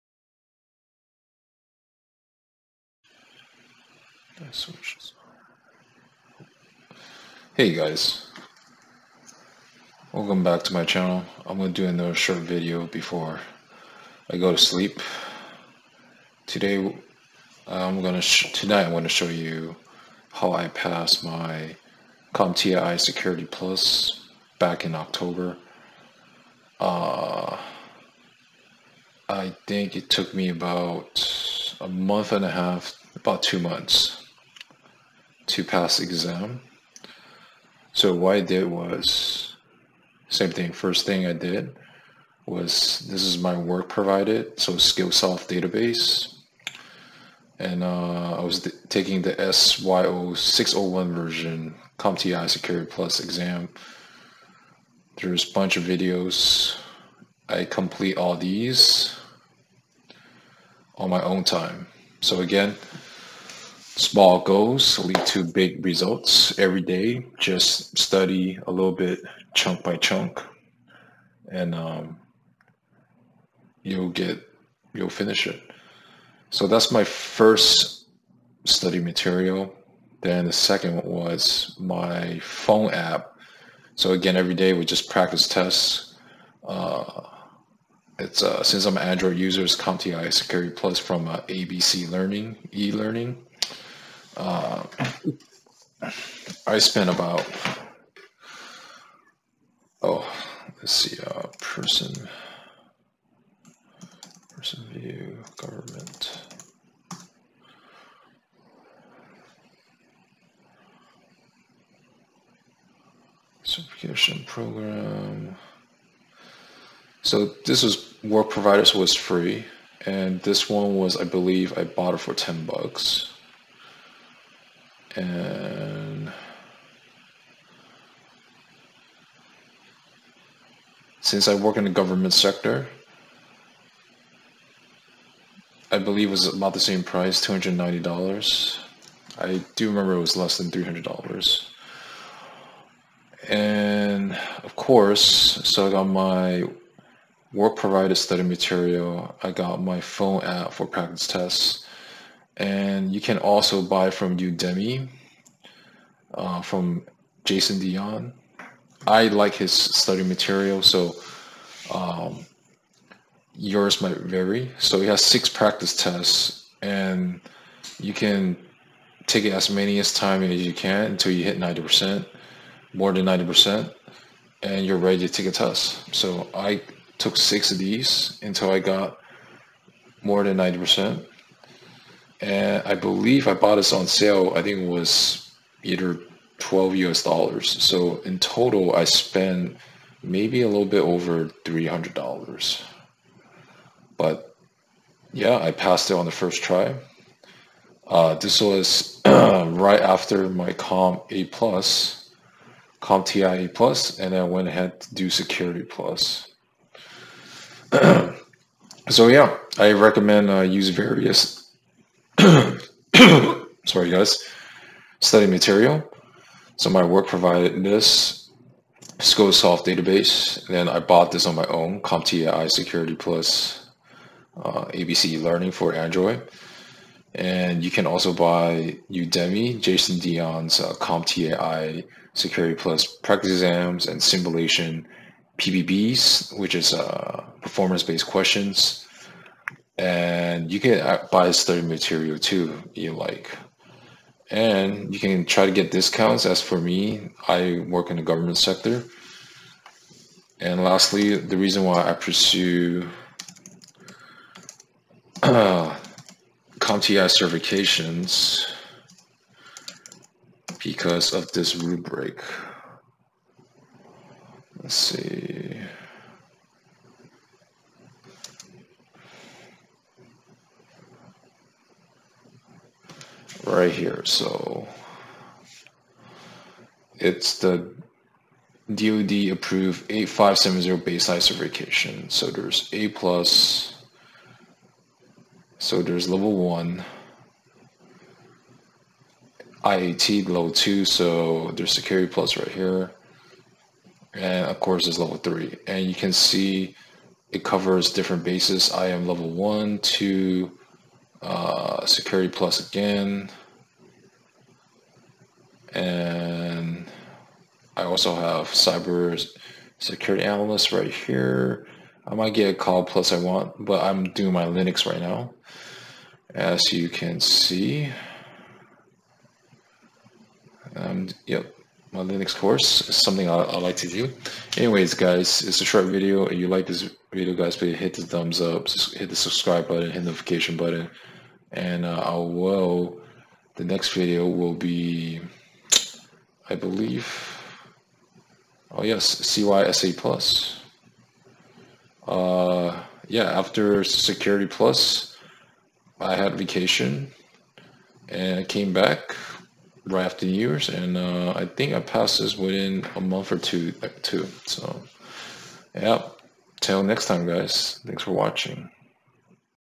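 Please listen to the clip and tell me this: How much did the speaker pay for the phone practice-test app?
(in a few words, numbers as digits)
10 dollars.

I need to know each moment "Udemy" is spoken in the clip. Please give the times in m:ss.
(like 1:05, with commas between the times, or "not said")
2:34, 3:49.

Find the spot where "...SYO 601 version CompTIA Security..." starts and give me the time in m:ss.
0:49.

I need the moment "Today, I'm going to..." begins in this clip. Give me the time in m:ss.
0:16.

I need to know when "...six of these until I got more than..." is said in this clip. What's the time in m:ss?
2:57.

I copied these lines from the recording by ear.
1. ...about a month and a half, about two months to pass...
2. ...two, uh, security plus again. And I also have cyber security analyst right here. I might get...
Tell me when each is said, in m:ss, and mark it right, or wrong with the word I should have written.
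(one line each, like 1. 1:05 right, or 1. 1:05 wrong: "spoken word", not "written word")
1. 0:30 right
2. 4:59 right.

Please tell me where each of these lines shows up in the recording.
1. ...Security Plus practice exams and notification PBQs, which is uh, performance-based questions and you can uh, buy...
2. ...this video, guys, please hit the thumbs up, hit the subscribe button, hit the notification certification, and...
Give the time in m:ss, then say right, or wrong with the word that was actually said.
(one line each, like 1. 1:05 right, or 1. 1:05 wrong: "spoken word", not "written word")
1. 3:52 wrong: "simulation", not "notification"
2. 5:26 wrong: "button", not "certification".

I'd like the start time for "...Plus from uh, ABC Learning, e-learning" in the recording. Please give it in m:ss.
1:30.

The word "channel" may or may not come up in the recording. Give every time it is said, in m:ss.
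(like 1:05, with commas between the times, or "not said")
0:10.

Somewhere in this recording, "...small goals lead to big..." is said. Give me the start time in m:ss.
1:03.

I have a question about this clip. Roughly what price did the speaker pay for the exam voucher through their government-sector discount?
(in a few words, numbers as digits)
$290.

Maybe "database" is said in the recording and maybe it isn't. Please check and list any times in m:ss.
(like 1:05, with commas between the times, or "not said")
0:45, 3:39.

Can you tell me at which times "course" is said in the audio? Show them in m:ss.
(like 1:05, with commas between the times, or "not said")
2:24, 4:54, 5:22.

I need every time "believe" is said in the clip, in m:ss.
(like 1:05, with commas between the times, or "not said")
2:01, 2:15, 3:02, 5:36.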